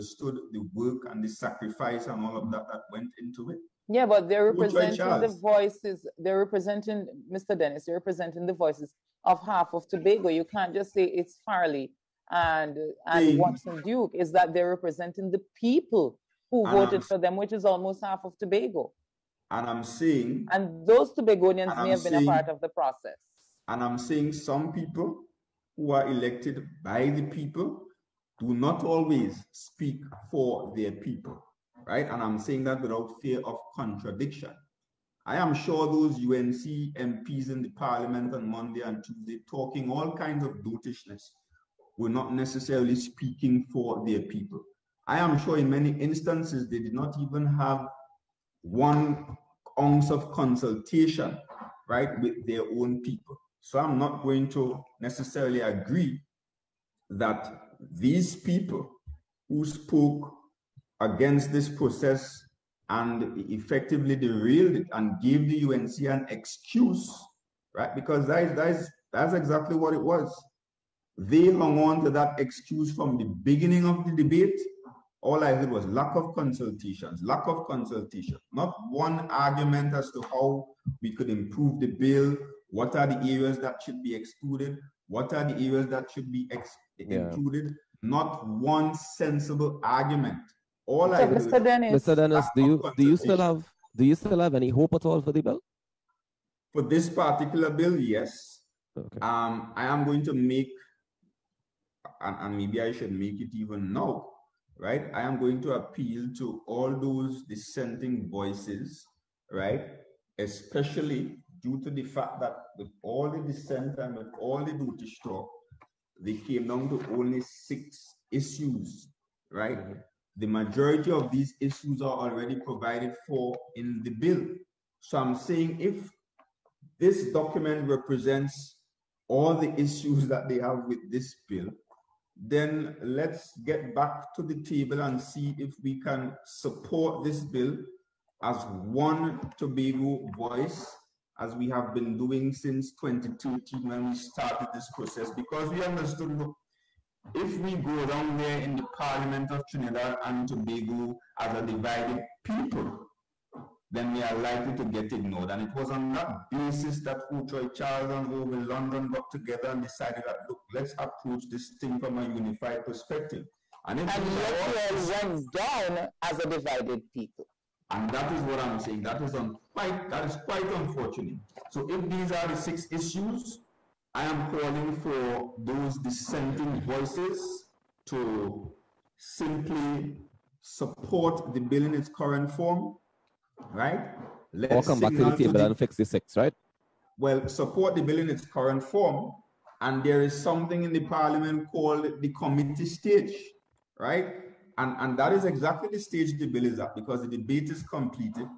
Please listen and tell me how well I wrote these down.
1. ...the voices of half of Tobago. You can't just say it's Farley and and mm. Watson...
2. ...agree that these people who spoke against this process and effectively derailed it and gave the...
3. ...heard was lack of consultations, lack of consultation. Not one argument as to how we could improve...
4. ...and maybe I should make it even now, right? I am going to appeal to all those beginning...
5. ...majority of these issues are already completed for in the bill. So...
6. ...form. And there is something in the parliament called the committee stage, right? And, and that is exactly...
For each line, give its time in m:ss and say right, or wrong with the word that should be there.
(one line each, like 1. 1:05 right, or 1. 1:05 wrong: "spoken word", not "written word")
1. 0:08 right
2. 0:55 right
3. 1:15 right
4. 1:42 wrong: "dissenting", not "beginning"
5. 2:00 wrong: "provided", not "completed"
6. 3:08 right.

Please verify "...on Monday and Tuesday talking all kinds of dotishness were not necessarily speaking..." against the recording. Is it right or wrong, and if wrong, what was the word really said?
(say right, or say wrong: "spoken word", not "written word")
right.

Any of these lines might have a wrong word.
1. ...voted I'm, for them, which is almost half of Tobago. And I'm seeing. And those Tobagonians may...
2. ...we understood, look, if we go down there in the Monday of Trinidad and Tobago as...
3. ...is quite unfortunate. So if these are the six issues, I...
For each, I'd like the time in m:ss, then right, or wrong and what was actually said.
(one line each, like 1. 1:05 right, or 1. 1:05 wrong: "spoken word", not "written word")
1. 0:16 right
2. 2:25 wrong: "Parliament", not "Monday"
3. 2:50 right.